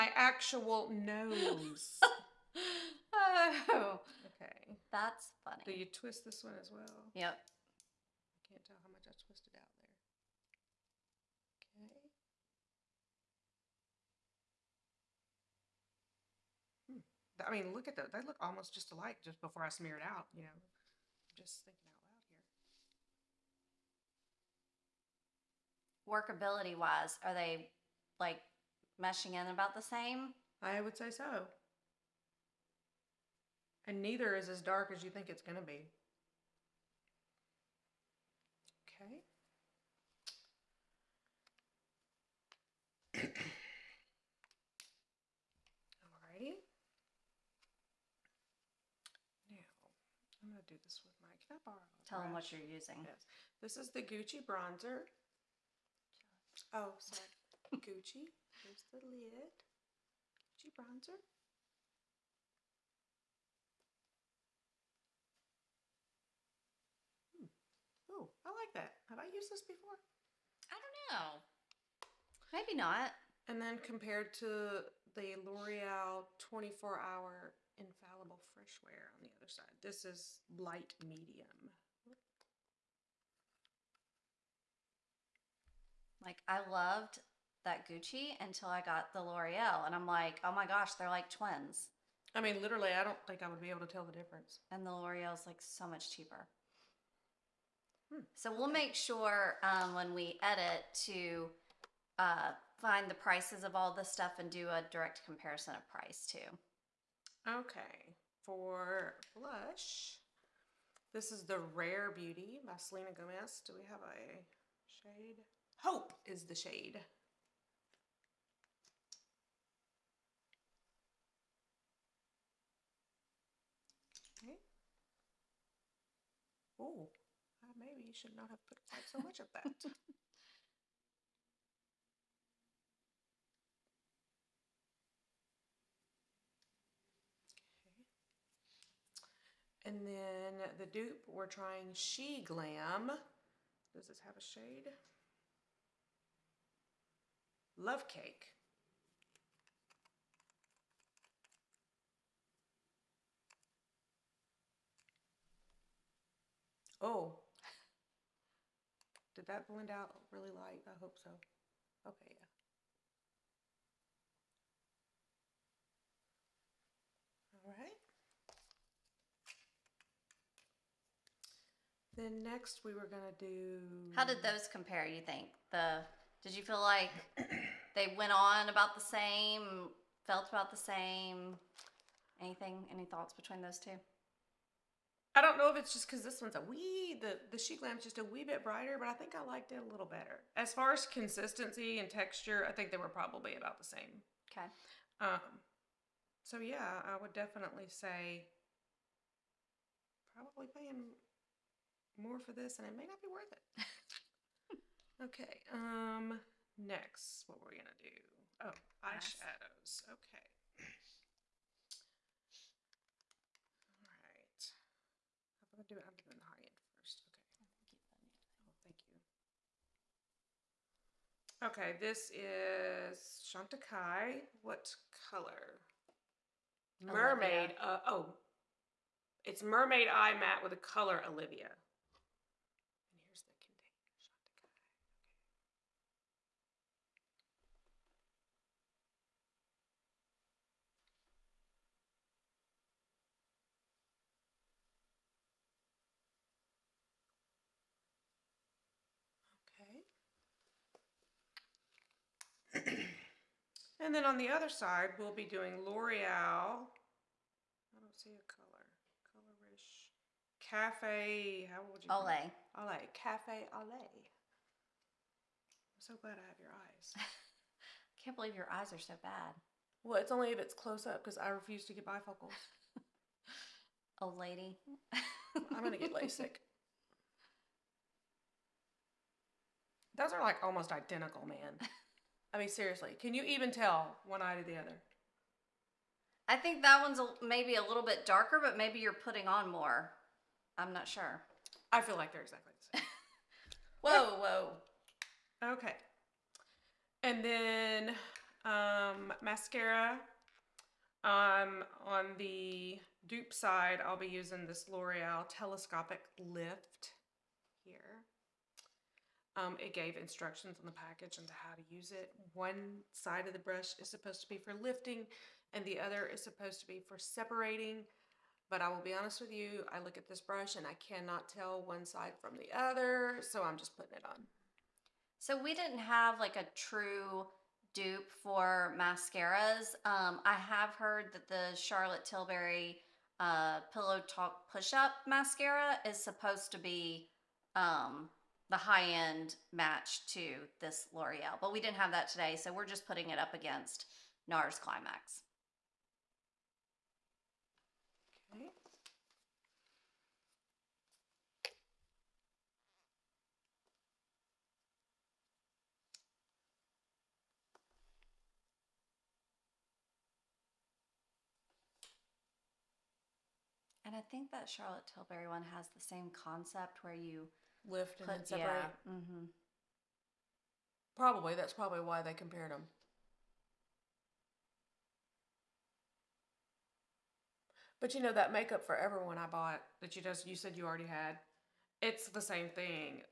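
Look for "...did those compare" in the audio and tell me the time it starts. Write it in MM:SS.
02:54.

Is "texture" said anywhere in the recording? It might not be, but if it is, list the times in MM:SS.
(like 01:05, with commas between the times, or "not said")
03:12.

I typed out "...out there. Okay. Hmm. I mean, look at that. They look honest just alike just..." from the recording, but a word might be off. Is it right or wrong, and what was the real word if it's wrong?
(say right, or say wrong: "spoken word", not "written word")
wrong: "almost", not "honest".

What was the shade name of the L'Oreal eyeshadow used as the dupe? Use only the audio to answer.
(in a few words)
Cafe Au Lait.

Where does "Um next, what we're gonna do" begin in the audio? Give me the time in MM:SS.
03:25.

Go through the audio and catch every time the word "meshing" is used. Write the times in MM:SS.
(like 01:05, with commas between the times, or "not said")
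00:29.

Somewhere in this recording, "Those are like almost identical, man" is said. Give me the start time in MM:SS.
04:40.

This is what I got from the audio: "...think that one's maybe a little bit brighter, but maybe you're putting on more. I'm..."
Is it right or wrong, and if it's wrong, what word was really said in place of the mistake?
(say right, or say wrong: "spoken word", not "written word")
wrong: "darker", not "brighter".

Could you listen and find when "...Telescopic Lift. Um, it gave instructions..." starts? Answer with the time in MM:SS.
05:05.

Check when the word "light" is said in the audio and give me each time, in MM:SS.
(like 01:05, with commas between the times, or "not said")
01:20, 02:40.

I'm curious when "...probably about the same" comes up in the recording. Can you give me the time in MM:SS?
03:13.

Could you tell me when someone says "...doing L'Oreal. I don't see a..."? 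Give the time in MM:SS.
04:15.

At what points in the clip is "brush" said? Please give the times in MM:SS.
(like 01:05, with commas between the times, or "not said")
05:13, 05:20.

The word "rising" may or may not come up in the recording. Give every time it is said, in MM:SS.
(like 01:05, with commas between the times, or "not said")
not said.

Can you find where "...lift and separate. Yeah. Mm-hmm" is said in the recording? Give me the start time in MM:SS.
06:07.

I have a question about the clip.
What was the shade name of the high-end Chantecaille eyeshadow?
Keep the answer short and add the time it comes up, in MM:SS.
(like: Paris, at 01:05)
Olivia, at 03:51.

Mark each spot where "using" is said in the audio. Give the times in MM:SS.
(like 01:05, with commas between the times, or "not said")
00:52, 05:04.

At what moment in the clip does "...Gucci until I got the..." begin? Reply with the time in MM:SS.
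01:27.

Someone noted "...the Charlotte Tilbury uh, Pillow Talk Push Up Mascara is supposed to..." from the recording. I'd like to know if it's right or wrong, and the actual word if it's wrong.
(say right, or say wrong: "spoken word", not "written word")
right.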